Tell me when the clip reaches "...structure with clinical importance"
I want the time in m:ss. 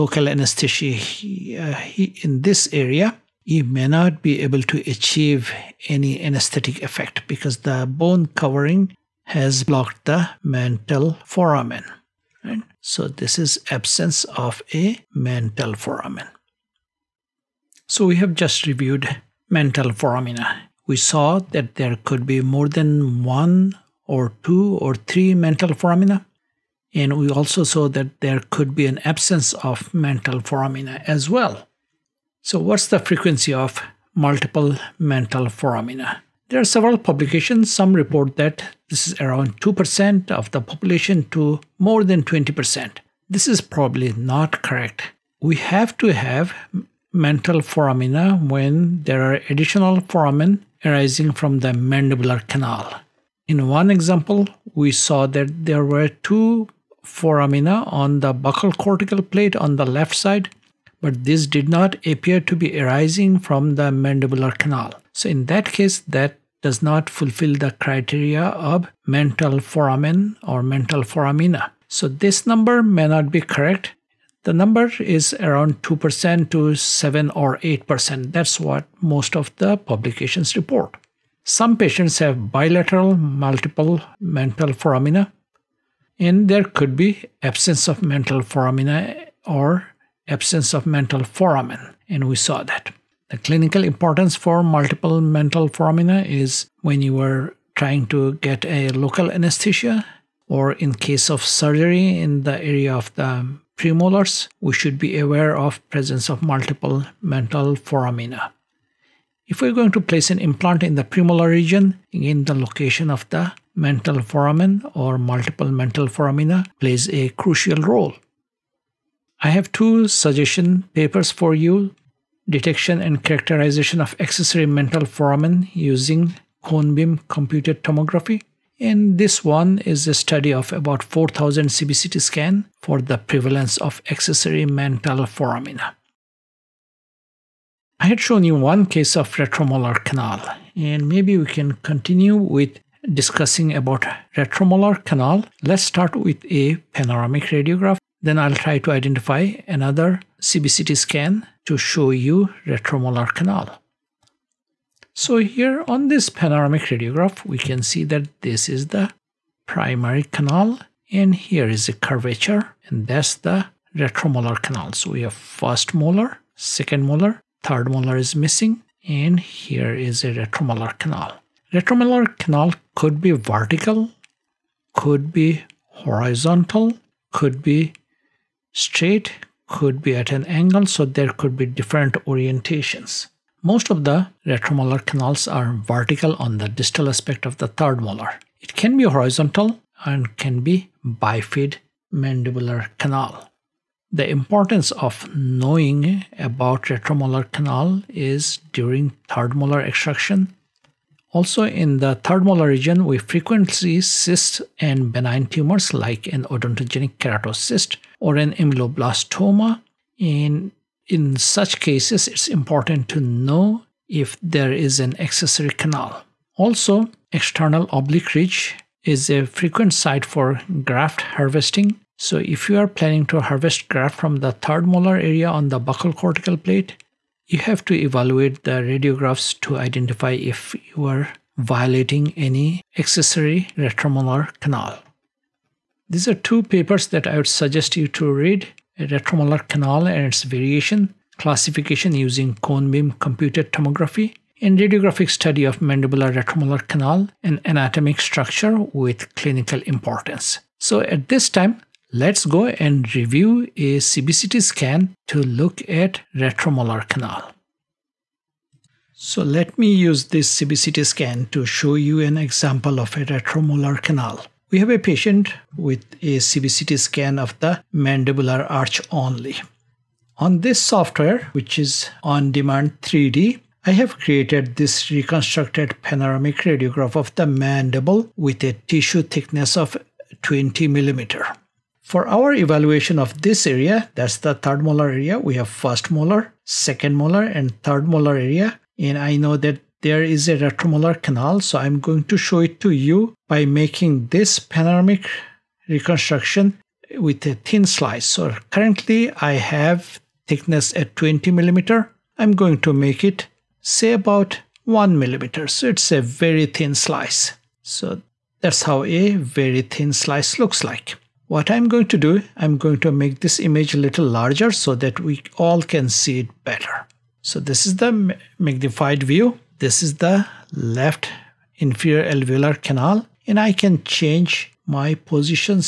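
4:08.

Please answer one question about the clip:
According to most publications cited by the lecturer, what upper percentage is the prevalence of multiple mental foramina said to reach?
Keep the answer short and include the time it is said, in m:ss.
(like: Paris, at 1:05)
7 or 8%, at 1:16.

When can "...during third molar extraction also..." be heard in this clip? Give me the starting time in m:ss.
3:18.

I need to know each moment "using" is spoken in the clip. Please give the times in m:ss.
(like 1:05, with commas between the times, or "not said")
2:05, 4:02.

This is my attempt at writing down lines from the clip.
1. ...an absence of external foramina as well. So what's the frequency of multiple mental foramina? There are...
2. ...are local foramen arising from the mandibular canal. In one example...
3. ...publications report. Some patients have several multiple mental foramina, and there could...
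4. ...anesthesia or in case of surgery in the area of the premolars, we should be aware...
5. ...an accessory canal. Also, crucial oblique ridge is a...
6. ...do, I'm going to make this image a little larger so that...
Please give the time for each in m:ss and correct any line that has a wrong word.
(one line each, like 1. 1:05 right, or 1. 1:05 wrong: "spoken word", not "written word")
1. 0:28 wrong: "mental", not "external"
2. 0:49 wrong: "additional", not "local"
3. 1:19 wrong: "bilateral", not "several"
4. 1:39 right
5. 3:34 wrong: "external", not "crucial"
6. 5:12 right.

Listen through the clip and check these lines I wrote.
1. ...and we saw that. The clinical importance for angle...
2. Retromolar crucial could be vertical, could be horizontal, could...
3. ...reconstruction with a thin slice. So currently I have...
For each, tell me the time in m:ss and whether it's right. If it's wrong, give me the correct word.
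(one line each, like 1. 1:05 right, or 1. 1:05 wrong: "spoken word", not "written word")
1. 1:32 wrong: "multiple", not "angle"
2. 2:51 wrong: "canal", not "crucial"
3. 4:55 right.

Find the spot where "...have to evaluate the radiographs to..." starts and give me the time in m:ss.
3:47.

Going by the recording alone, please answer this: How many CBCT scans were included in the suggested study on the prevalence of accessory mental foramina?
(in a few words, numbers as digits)
4000.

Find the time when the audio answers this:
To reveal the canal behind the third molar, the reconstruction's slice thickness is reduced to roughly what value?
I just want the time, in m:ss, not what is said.
5:04.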